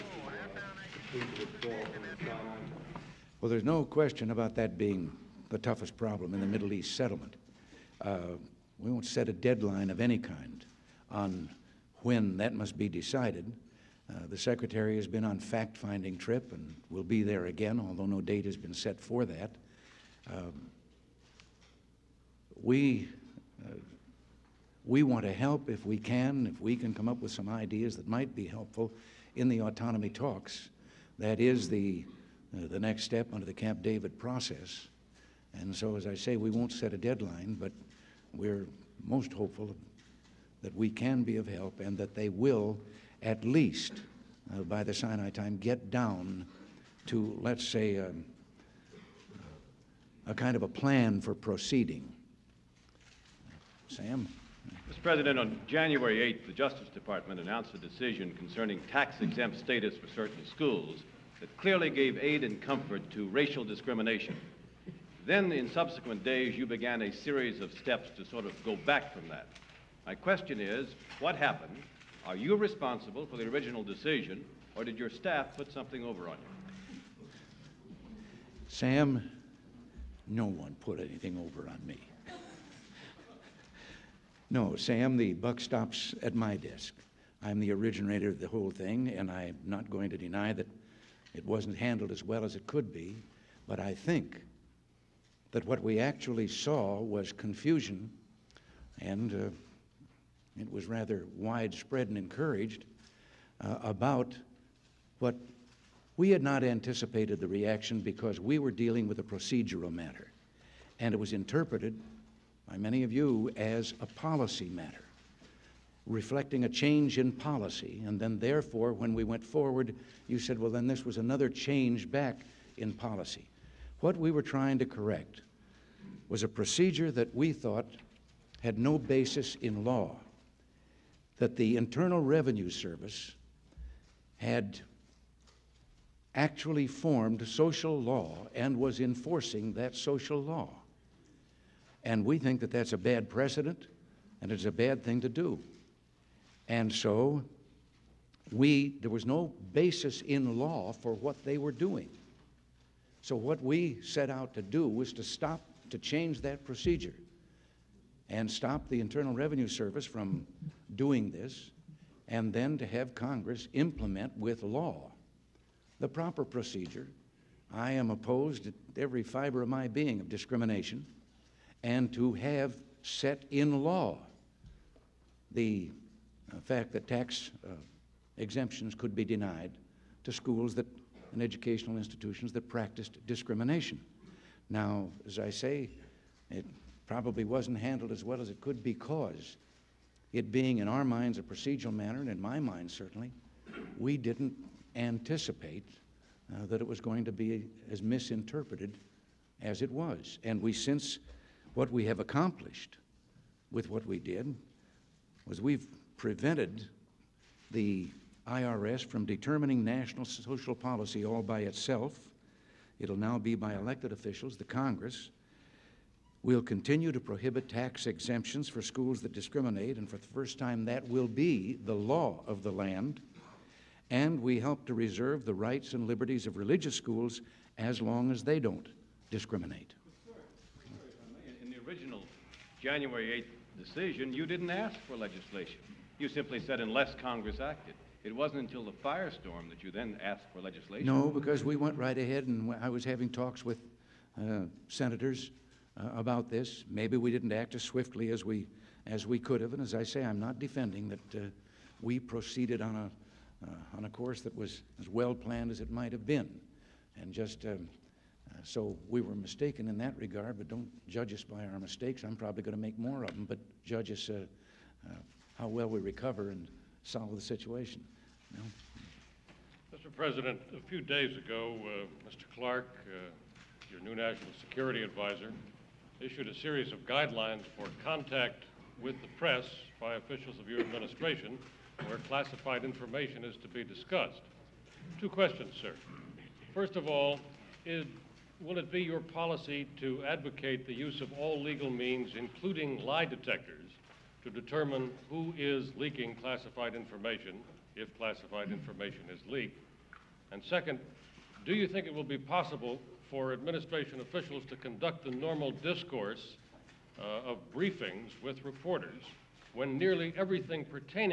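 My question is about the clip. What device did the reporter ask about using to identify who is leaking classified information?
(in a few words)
Lie detectors.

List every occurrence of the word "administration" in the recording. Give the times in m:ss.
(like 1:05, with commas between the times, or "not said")
4:40, 5:03.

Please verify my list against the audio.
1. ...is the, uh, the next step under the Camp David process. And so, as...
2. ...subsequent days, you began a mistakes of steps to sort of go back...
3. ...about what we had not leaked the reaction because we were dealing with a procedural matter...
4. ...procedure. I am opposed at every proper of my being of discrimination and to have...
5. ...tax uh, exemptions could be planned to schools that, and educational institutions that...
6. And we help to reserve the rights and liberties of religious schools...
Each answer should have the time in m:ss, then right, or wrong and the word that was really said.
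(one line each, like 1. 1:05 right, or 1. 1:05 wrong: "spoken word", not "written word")
1. 0:31 right
2. 1:05 wrong: "series", not "mistakes"
3. 1:43 wrong: "anticipated", not "leaked"
4. 2:46 wrong: "fiber", not "proper"
5. 2:57 wrong: "denied", not "planned"
6. 3:44 right.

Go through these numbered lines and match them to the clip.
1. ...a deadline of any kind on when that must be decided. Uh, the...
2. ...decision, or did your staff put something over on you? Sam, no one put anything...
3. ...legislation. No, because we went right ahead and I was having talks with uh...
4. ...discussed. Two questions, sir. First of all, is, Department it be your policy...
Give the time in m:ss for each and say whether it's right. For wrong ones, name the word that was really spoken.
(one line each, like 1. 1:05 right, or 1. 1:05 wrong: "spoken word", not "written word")
1. 0:09 right
2. 1:13 right
3. 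4:00 right
4. 4:43 wrong: "Will", not "Department".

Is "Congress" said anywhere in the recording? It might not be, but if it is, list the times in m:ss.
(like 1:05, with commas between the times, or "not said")
2:43, 3:34, 3:57.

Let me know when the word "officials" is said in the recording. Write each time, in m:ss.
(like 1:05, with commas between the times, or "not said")
3:34, 4:40, 5:04.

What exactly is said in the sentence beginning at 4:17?
And just um, so we were mistaken in that regard, but don't judge us by our mistakes.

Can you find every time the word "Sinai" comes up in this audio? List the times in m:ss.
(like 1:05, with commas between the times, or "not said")
0:02, 0:44.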